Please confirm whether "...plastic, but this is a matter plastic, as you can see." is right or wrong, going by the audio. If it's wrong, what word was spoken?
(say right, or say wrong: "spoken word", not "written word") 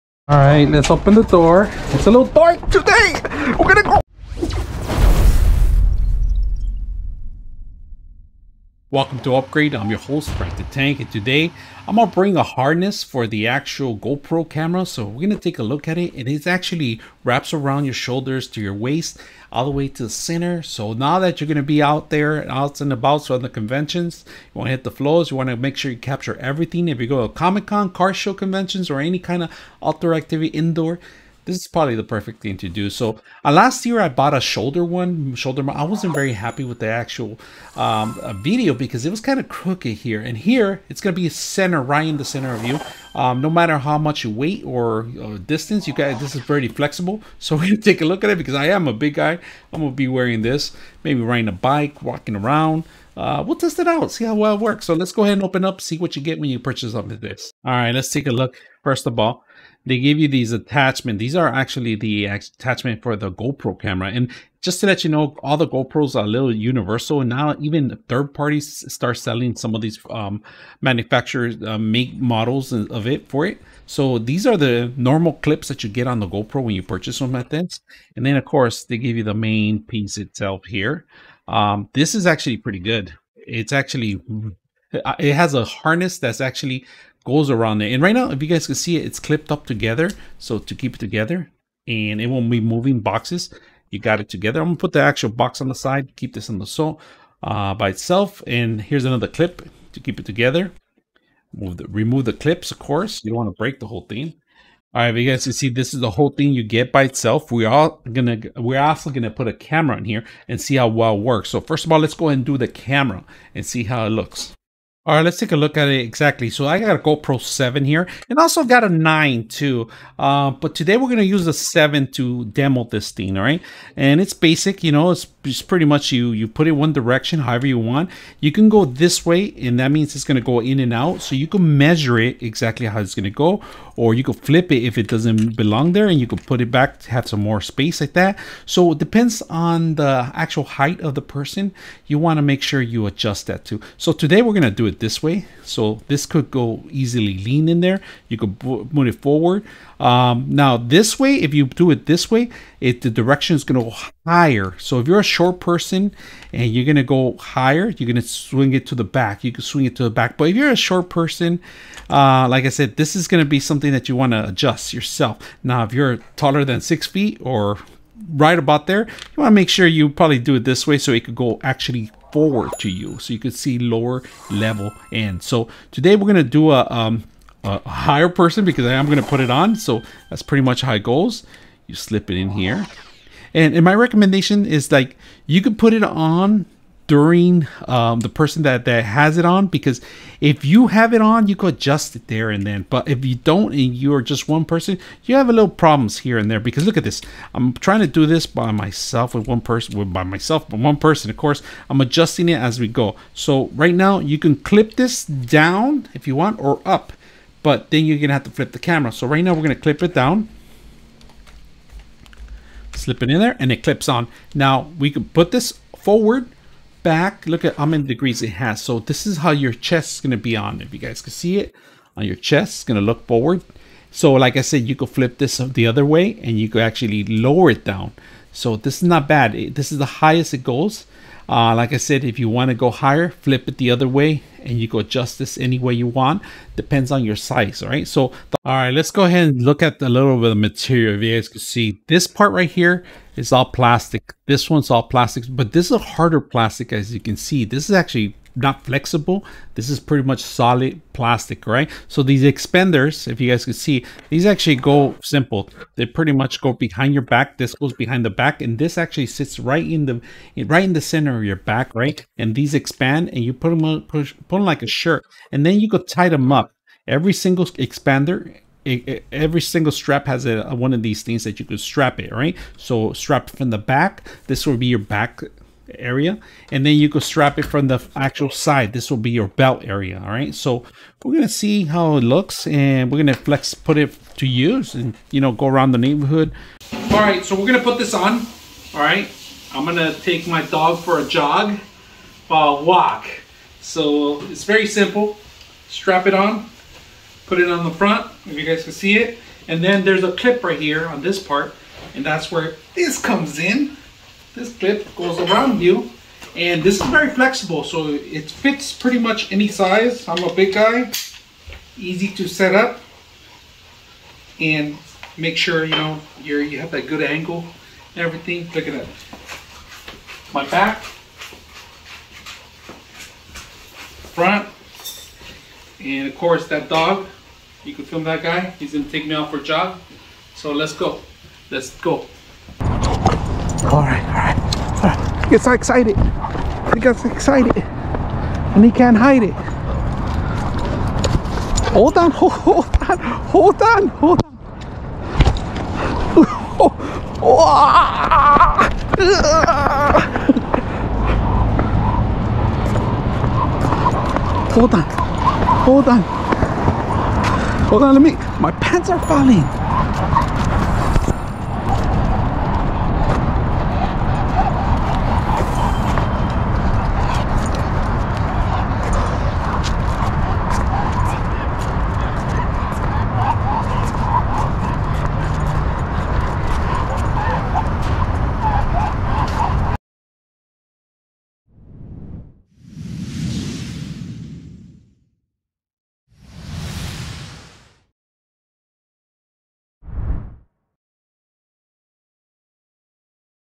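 wrong: "harder", not "matter".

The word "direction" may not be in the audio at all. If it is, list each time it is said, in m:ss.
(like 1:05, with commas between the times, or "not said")
2:06, 2:33.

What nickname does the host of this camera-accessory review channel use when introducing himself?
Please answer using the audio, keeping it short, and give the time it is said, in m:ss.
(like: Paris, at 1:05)
Frank the Tank, at 0:10.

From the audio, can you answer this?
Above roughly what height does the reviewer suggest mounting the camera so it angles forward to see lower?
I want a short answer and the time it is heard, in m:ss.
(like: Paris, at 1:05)
6 feet, at 2:46.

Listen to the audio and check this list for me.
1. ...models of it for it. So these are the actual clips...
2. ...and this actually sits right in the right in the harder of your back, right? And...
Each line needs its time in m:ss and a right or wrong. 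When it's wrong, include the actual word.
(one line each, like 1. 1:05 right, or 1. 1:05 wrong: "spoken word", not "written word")
1. 1:12 wrong: "normal", not "actual"
2. 4:18 wrong: "center", not "harder".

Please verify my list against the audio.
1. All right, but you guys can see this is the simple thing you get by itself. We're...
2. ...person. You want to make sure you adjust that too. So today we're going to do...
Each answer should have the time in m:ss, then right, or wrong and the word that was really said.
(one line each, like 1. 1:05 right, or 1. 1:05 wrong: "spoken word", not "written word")
1. 1:44 wrong: "whole", not "simple"
2. 2:21 right.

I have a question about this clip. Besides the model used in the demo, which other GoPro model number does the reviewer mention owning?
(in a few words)
9.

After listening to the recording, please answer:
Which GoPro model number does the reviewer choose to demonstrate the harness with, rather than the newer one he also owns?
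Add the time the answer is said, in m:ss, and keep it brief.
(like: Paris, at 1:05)
7, at 1:56.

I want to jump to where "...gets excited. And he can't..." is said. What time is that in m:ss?
5:37.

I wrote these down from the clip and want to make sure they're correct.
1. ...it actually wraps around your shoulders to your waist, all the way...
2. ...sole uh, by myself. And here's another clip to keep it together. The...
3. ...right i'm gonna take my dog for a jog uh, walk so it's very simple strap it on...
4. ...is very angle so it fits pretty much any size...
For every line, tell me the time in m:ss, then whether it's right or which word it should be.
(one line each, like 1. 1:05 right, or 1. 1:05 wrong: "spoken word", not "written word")
1. 0:16 right
2. 1:36 wrong: "itself", not "myself"
3. 4:49 right
4. 5:07 wrong: "flexible", not "angle".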